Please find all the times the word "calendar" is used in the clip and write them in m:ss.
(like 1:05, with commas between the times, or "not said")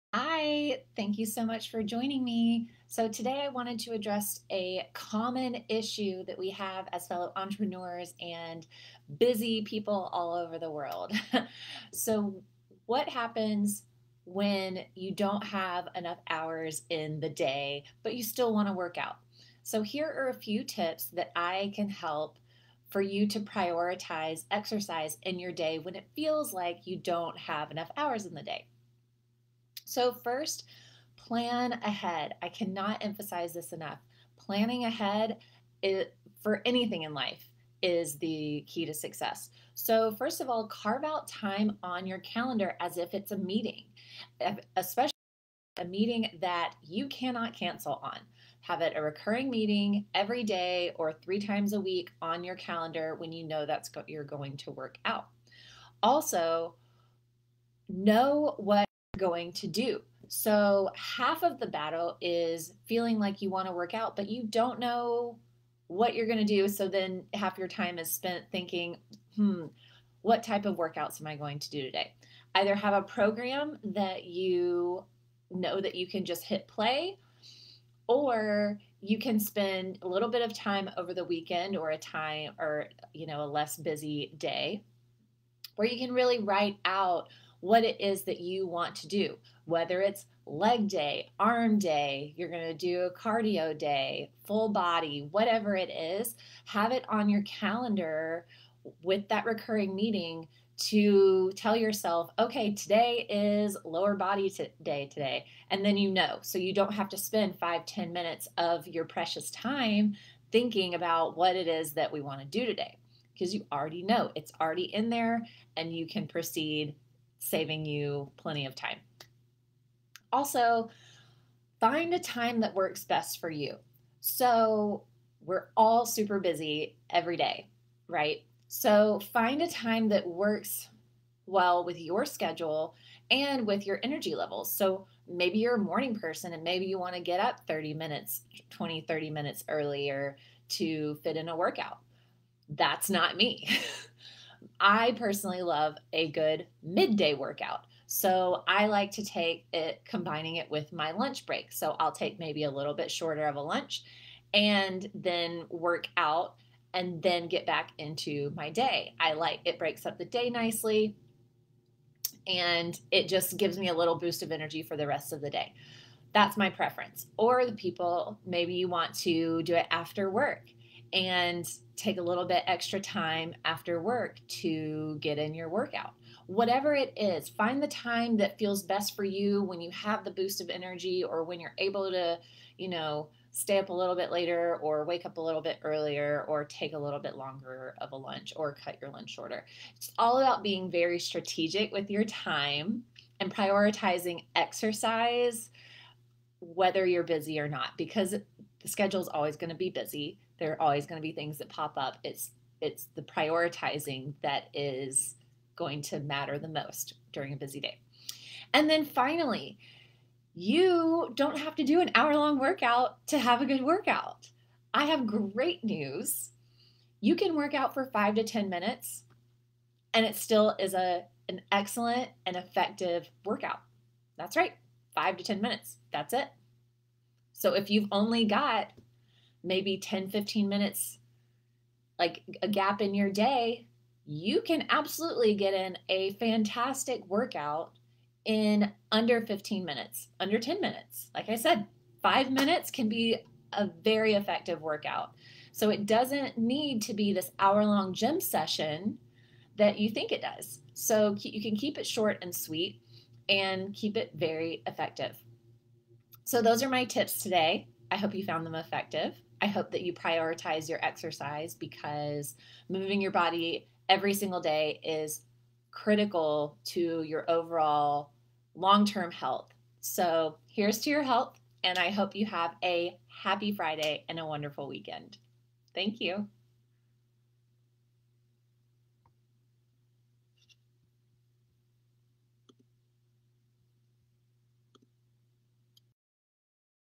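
0:42, 0:52, 1:37.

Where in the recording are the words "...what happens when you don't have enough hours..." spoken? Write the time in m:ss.
0:12.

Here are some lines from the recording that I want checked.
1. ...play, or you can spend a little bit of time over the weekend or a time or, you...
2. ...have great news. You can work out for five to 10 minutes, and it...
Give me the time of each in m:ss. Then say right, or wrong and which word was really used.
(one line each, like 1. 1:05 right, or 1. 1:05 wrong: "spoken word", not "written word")
1. 1:16 right
2. 3:35 right.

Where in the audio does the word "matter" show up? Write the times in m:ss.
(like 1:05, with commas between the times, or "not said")
3:26.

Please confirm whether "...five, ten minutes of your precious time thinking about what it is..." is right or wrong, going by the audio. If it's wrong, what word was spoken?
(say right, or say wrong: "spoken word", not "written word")
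right.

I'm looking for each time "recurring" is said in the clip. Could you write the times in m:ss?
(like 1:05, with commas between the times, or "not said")
0:49, 1:39.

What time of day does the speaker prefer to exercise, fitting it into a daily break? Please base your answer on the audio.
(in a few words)
midday.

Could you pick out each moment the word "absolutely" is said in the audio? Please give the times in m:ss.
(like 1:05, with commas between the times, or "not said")
3:54.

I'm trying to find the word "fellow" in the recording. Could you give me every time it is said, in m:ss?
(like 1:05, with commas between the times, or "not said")
0:07.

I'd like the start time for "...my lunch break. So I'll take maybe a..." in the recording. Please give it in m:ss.
2:30.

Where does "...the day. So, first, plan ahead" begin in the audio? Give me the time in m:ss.
0:28.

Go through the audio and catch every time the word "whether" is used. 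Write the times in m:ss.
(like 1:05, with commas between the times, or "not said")
1:29, 3:16.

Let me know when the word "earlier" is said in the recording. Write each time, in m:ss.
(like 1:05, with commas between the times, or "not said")
2:19, 3:05.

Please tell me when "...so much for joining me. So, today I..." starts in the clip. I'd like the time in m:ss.
0:01.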